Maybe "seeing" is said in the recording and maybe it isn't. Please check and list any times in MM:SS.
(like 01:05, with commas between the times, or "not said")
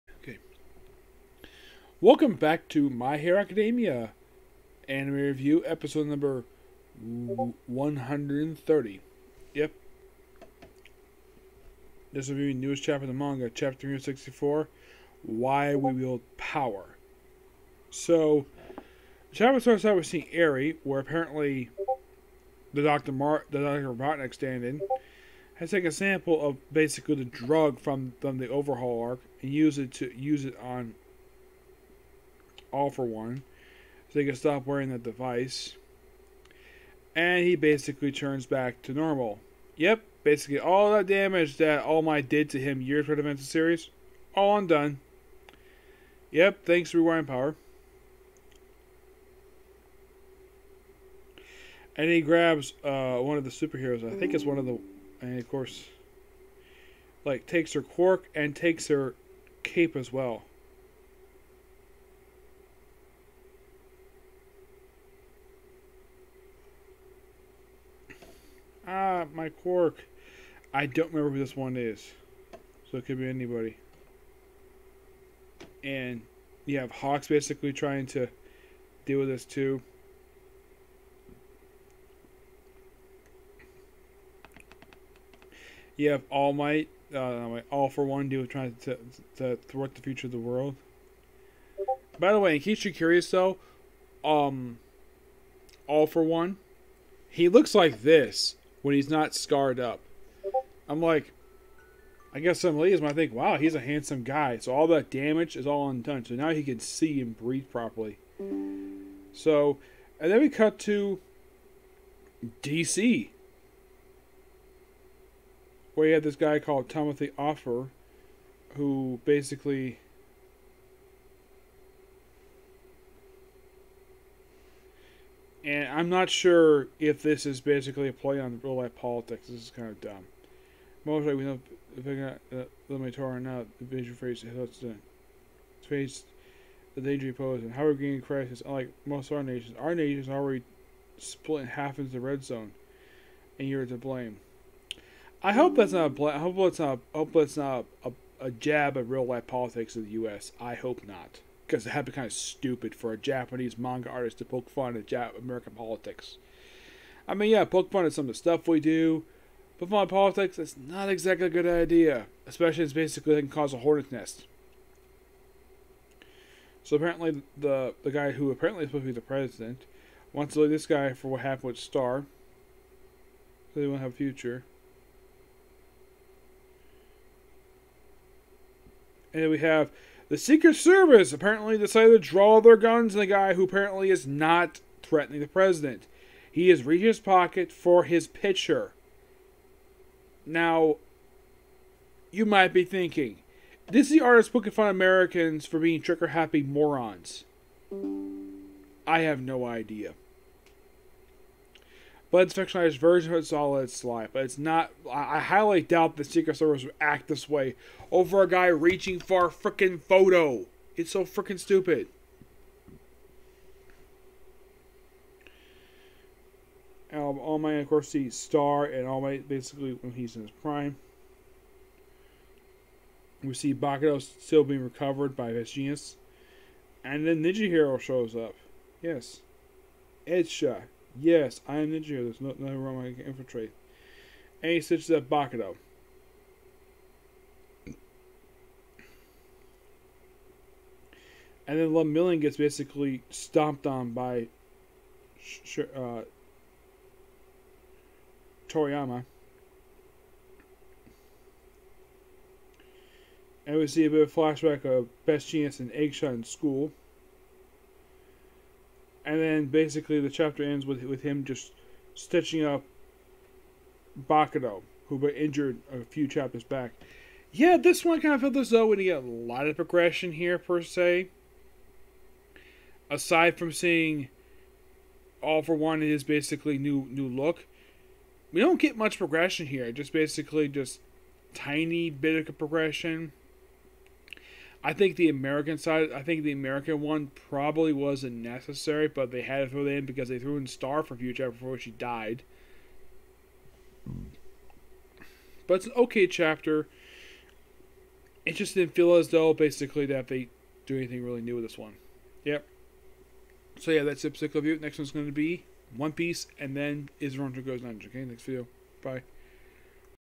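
00:20, 04:33.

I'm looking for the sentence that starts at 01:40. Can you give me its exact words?
I'm like, I guess some ladies might think, wow, he's a handsome guy.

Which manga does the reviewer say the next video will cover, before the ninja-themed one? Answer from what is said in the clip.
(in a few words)
One Piece.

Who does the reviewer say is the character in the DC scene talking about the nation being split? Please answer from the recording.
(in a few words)
Timothy Offer.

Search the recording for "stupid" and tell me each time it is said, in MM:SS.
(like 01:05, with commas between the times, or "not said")
02:32, 03:31.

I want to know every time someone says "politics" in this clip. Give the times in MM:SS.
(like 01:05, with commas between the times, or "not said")
02:08, 02:29, 02:35, 02:40.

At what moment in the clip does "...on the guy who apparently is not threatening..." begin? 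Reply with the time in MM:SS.
03:03.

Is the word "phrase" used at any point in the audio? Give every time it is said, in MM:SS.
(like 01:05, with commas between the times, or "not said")
02:14.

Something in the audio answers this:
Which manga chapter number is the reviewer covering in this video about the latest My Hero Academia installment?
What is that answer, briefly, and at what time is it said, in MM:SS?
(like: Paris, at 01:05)
364, at 00:13.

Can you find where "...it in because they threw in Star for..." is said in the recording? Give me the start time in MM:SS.
04:49.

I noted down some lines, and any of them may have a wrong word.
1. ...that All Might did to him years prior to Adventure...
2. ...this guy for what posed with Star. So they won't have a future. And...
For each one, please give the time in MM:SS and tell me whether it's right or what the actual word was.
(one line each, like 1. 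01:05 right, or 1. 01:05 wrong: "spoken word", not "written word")
1. 00:41 right
2. 02:50 wrong: "happened", not "posed".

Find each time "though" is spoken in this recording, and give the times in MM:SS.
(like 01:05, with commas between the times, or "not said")
01:33, 04:28, 04:59.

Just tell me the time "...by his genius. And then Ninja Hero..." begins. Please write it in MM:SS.
03:45.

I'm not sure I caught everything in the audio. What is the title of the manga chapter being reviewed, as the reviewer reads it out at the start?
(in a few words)
Why We Wield Power.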